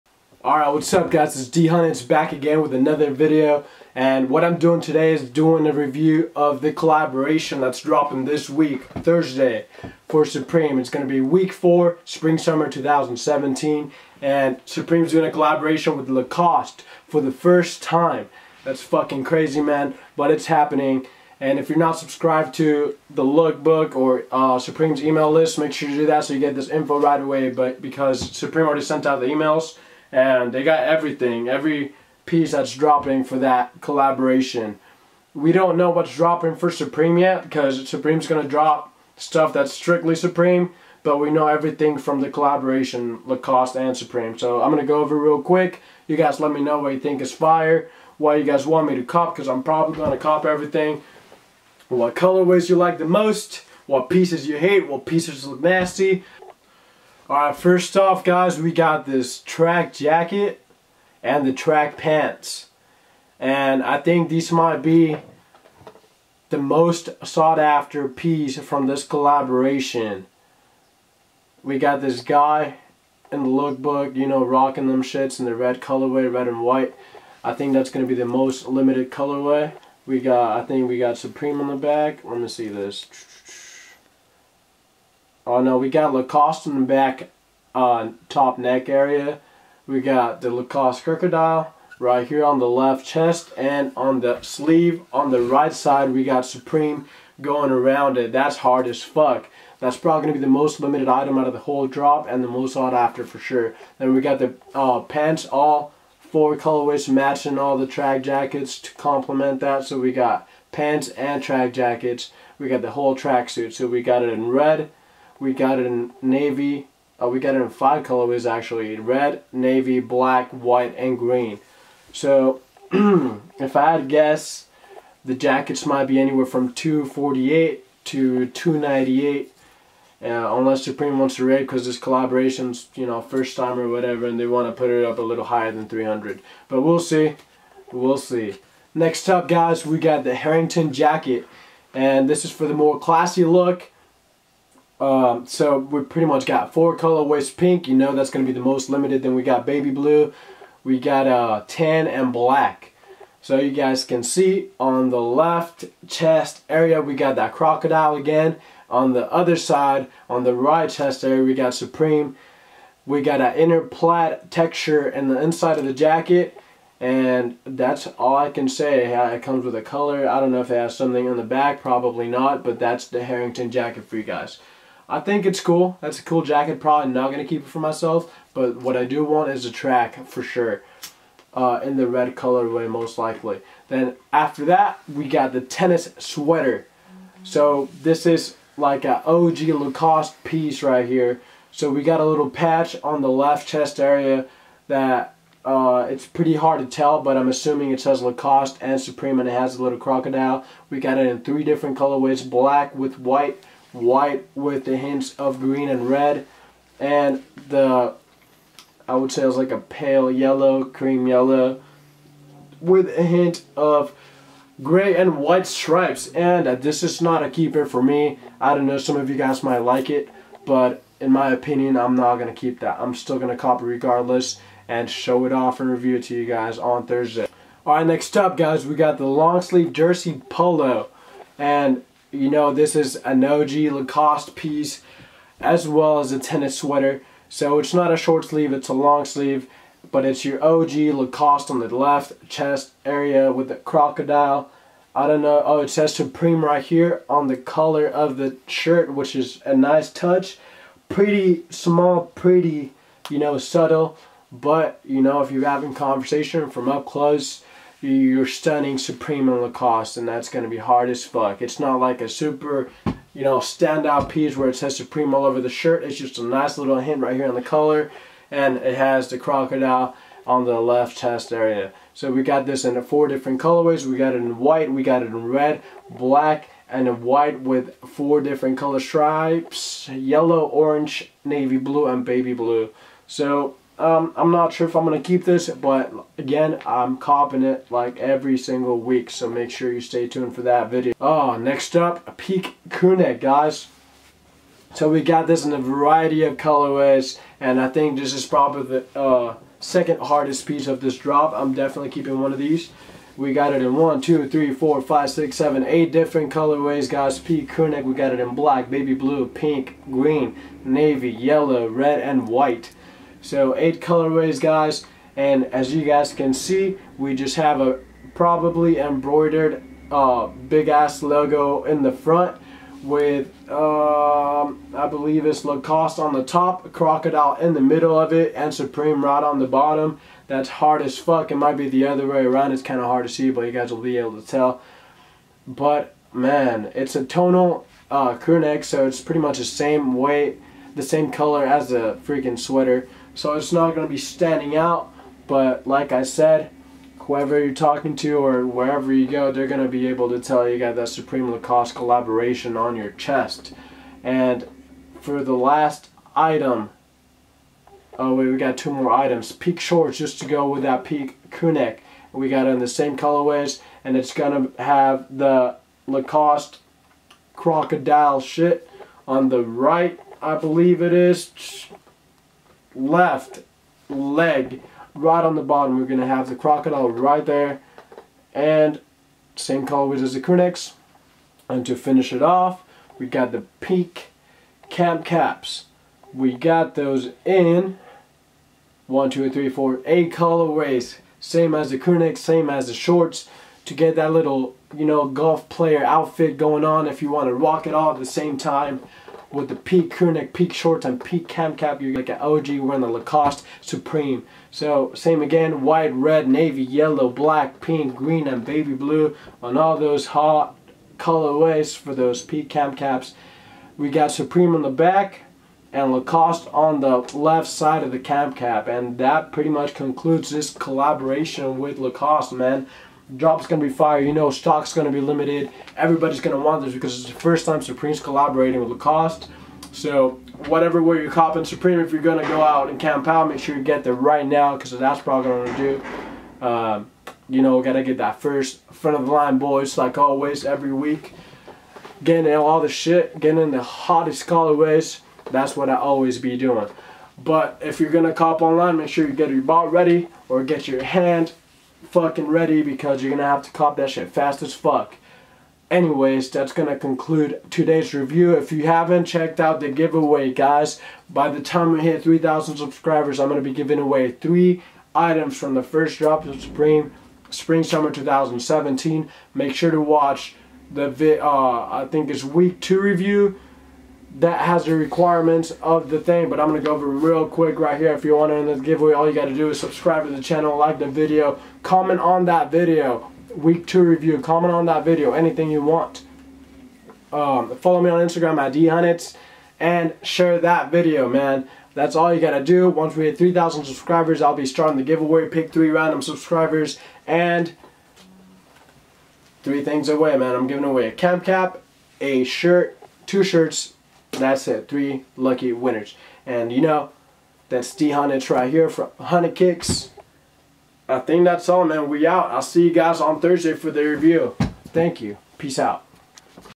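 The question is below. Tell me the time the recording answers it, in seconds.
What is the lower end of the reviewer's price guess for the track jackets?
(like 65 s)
126 s.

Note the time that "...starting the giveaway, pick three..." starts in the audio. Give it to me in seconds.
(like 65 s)
494 s.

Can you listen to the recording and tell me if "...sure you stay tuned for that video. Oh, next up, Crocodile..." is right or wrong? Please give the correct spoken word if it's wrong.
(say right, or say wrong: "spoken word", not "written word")
wrong: "Peak", not "Crocodile".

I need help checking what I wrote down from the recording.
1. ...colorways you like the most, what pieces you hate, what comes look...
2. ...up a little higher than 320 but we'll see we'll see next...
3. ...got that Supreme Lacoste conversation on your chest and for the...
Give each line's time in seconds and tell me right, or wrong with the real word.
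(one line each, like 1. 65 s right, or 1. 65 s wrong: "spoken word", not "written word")
1. 52 s wrong: "pieces", not "comes"
2. 135 s wrong: "300", not "320"
3. 350 s wrong: "collaboration", not "conversation".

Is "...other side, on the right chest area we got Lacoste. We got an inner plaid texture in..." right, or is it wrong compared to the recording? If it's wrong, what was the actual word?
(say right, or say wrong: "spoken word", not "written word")
wrong: "Supreme", not "Lacoste".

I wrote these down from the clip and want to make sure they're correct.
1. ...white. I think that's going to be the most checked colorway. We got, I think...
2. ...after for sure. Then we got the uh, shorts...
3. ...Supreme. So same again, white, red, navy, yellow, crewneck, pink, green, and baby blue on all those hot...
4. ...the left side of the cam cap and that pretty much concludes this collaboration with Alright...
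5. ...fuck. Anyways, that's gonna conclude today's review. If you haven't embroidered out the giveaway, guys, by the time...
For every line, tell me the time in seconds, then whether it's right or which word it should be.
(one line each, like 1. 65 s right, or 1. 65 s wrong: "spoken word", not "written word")
1. 76 s wrong: "limited", not "checked"
2. 102 s wrong: "pants", not "shorts"
3. 403 s wrong: "black", not "crewneck"
4. 417 s wrong: "Lacoste", not "Alright"
5. 454 s wrong: "checked", not "embroidered".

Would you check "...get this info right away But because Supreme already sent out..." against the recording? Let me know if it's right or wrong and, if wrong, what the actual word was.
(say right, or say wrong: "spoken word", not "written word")
right.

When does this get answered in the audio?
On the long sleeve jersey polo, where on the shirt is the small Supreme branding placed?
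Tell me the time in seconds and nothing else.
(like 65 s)
247 s.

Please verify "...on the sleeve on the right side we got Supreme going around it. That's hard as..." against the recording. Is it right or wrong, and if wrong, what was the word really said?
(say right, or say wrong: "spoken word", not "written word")
right.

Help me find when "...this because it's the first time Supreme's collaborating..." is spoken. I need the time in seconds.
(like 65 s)
426 s.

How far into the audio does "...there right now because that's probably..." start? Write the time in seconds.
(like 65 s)
434 s.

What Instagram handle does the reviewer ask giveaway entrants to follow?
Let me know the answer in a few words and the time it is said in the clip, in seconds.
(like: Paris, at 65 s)
dhunnits, at 488 s.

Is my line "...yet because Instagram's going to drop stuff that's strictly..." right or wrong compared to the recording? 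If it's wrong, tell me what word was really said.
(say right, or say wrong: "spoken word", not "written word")
wrong: "Supreme", not "Instagram".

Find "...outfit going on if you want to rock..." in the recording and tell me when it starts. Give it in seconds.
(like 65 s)
396 s.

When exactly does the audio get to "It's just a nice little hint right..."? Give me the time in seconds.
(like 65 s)
266 s.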